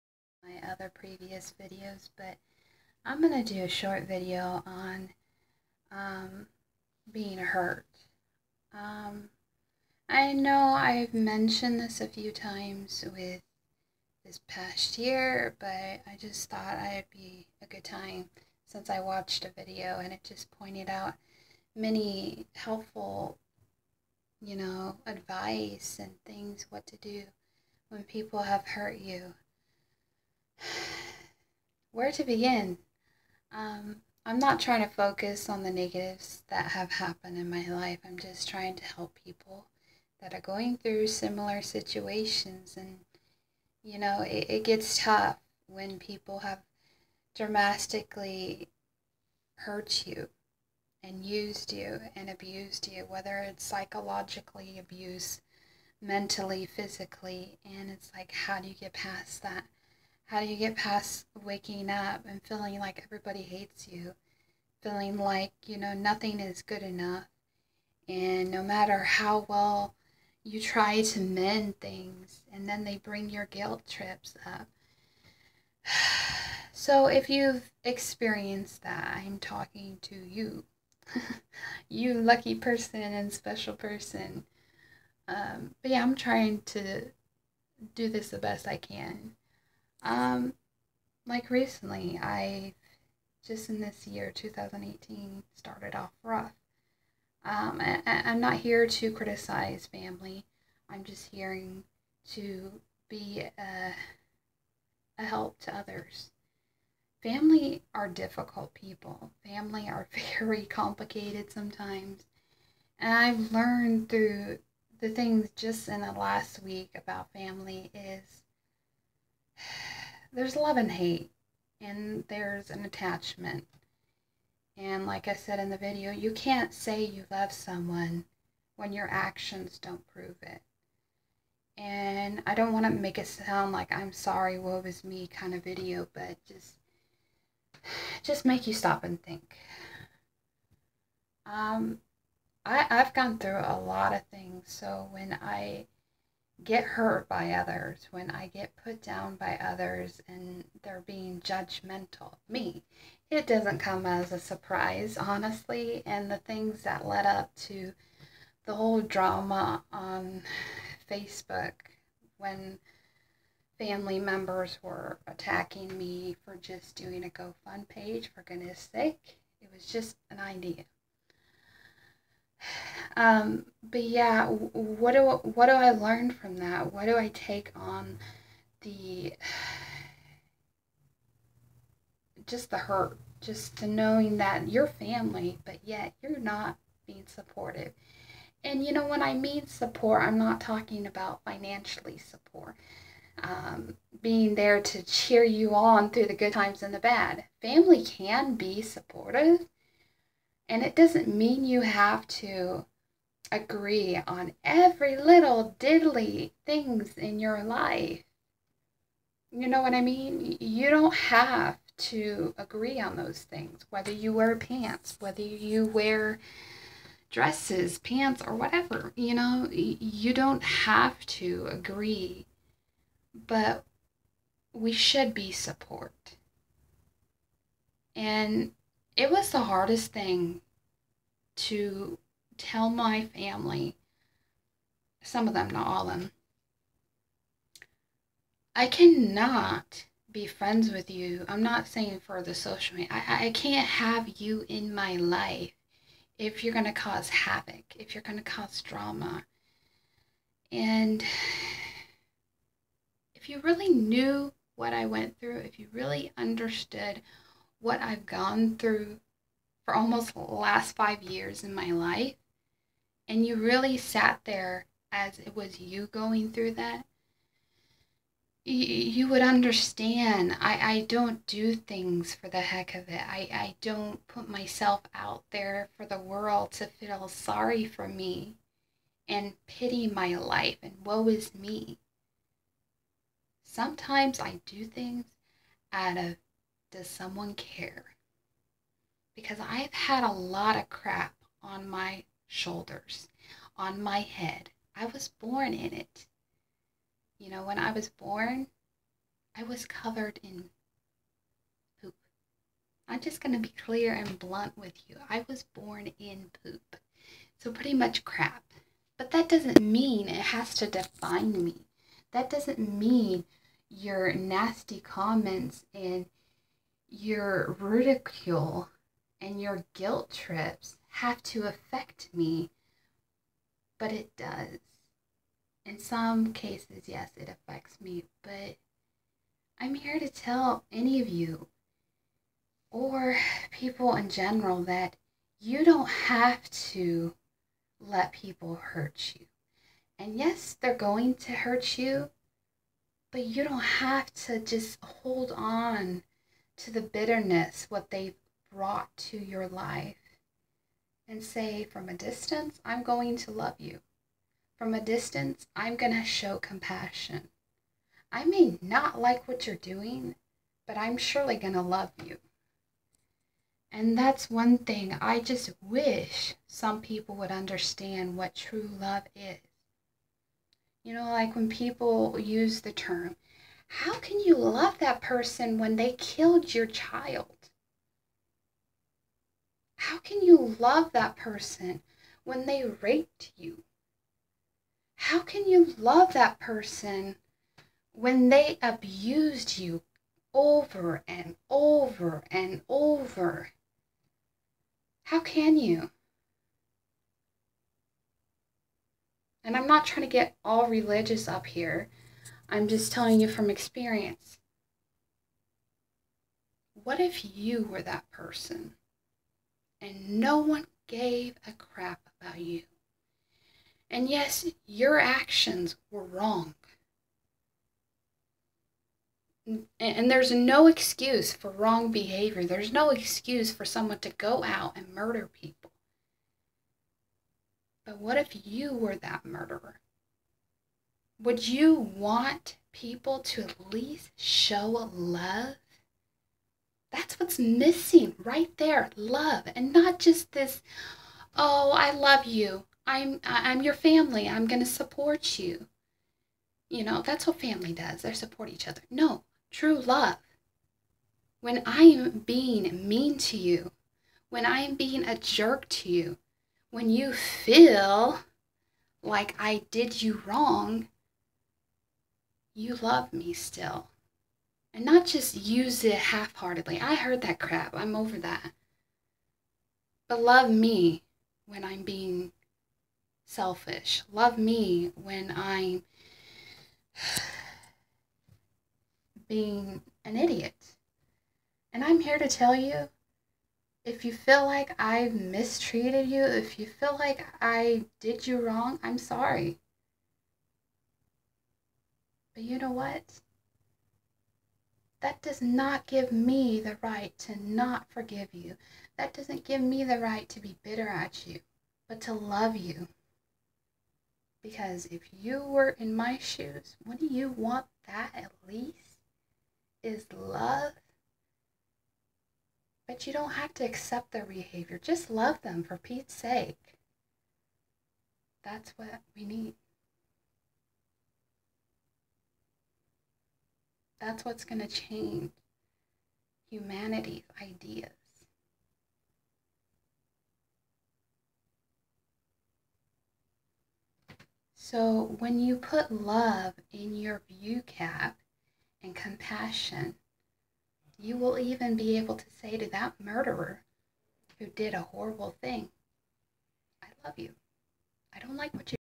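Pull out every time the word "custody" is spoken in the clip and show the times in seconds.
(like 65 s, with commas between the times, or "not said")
not said.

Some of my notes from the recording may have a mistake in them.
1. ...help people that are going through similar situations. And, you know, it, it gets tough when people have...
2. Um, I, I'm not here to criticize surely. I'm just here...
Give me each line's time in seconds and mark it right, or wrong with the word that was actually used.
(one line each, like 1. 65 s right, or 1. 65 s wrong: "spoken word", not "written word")
1. 38 s right
2. 97 s wrong: "family", not "surely".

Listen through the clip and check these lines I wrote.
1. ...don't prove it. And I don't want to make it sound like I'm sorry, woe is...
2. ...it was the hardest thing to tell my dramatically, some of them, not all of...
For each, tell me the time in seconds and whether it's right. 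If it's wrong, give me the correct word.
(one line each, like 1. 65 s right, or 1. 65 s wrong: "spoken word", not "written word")
1. 129 s right
2. 229 s wrong: "family", not "dramatically".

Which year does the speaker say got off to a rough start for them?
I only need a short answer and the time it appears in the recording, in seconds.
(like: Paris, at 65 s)
2018, at 94 s.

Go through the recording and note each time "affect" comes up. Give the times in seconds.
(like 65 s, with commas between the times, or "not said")
321 s, 327 s.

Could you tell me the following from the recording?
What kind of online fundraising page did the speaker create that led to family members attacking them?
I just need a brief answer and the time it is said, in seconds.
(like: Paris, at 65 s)
GoFund page, at 167 s.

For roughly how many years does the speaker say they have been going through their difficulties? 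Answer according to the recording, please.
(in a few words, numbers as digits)
5.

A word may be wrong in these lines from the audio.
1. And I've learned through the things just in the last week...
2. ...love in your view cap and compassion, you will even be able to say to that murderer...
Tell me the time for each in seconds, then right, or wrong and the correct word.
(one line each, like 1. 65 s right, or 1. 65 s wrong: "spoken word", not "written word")
1. 112 s right
2. 536 s right.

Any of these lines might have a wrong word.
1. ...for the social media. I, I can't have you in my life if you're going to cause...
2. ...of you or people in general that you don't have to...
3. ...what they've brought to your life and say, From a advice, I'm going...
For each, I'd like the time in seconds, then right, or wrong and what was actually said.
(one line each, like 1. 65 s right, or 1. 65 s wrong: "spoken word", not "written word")
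1. 242 s right
2. 331 s right
3. 347 s wrong: "distance", not "advice".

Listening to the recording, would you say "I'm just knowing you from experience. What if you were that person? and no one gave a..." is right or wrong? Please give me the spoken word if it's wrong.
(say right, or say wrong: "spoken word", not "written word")
wrong: "telling", not "knowing".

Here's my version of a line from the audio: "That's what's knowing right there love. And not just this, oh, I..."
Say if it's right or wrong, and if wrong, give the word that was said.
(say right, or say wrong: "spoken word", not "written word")
wrong: "missing", not "knowing".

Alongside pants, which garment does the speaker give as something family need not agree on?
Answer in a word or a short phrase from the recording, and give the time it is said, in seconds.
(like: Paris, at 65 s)
dresses, at 217 s.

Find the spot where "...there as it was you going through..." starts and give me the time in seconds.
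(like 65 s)
264 s.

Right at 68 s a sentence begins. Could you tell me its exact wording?
And no matter how well you try to mend things, and then they bring your guilt trips up.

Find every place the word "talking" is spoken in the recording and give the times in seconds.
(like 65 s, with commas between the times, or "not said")
79 s, 190 s.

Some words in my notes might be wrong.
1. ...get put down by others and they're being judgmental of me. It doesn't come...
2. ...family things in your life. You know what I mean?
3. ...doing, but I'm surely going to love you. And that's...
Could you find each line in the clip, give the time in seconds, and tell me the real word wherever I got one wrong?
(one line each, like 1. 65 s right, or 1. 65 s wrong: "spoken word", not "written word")
1. 148 s right
2. 205 s wrong: "diddly", not "family"
3. 359 s right.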